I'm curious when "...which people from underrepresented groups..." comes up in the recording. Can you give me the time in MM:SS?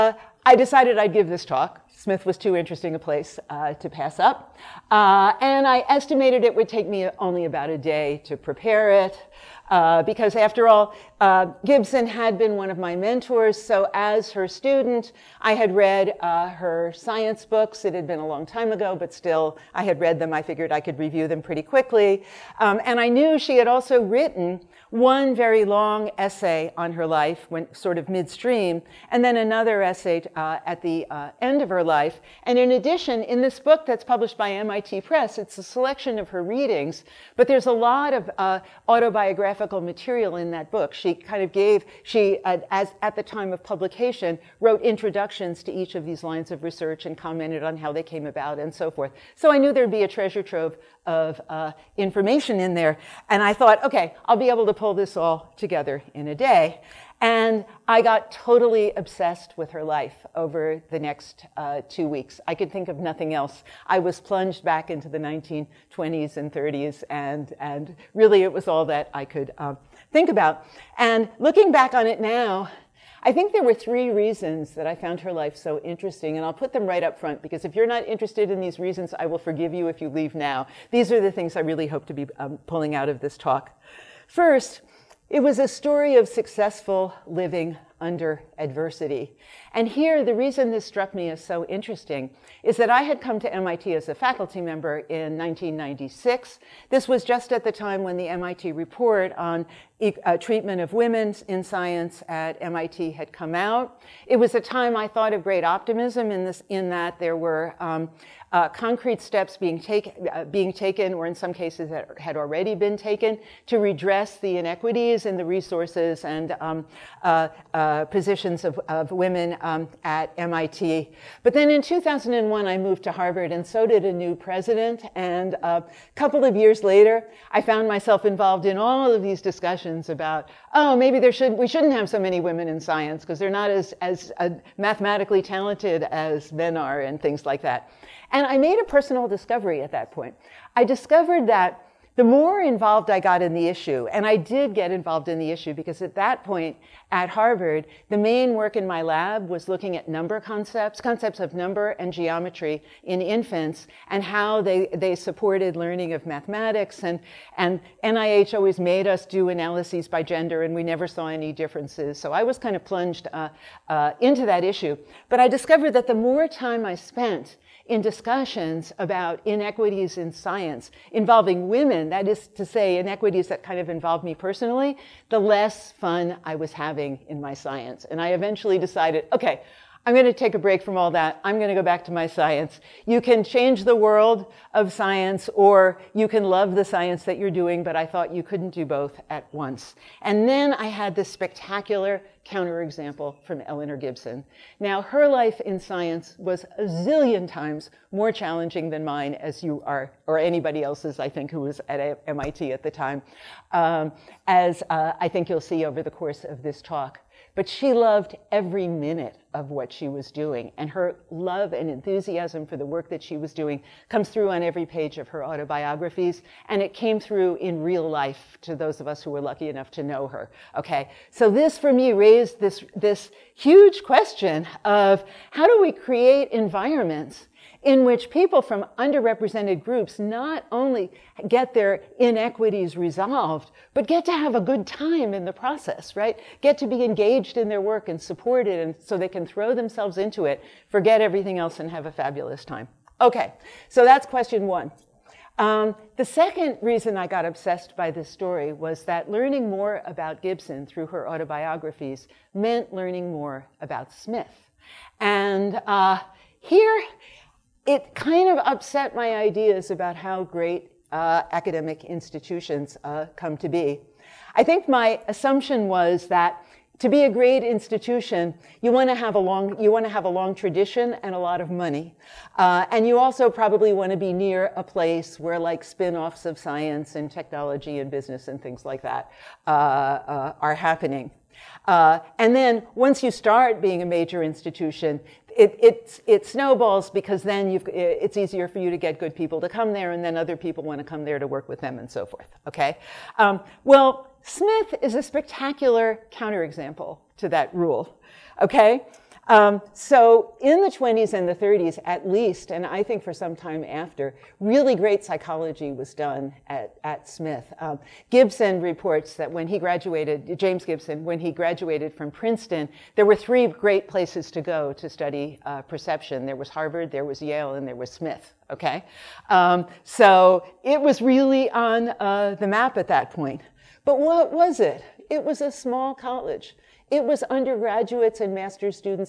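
03:48.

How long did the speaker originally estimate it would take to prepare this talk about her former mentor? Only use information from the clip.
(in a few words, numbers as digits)
About a day.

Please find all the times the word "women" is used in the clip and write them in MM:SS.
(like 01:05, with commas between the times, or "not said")
01:40, 01:59, 02:12, 02:51.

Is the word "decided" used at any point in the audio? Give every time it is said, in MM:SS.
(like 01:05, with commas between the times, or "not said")
00:00, 02:58.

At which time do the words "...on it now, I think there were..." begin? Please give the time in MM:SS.
01:11.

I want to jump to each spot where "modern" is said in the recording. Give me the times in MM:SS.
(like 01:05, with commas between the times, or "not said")
not said.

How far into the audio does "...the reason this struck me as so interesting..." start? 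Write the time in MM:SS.
01:30.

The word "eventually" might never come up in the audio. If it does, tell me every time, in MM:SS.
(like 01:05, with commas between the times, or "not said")
02:58.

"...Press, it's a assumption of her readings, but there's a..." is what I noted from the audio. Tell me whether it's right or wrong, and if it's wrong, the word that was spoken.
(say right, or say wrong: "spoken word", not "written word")
wrong: "selection", not "assumption".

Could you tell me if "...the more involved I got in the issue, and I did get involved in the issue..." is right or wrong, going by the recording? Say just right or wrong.
right.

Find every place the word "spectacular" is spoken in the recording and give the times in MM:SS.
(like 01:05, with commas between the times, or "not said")
03:11, 04:55.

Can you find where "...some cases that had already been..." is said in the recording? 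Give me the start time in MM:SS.
01:51.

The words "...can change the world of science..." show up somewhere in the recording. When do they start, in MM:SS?
03:03.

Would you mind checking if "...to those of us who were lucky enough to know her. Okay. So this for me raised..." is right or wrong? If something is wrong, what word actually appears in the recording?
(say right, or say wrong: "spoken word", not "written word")
right.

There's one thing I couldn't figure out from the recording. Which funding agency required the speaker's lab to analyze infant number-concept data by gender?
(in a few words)
NIH.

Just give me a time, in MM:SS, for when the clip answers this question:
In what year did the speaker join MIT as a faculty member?
01:35.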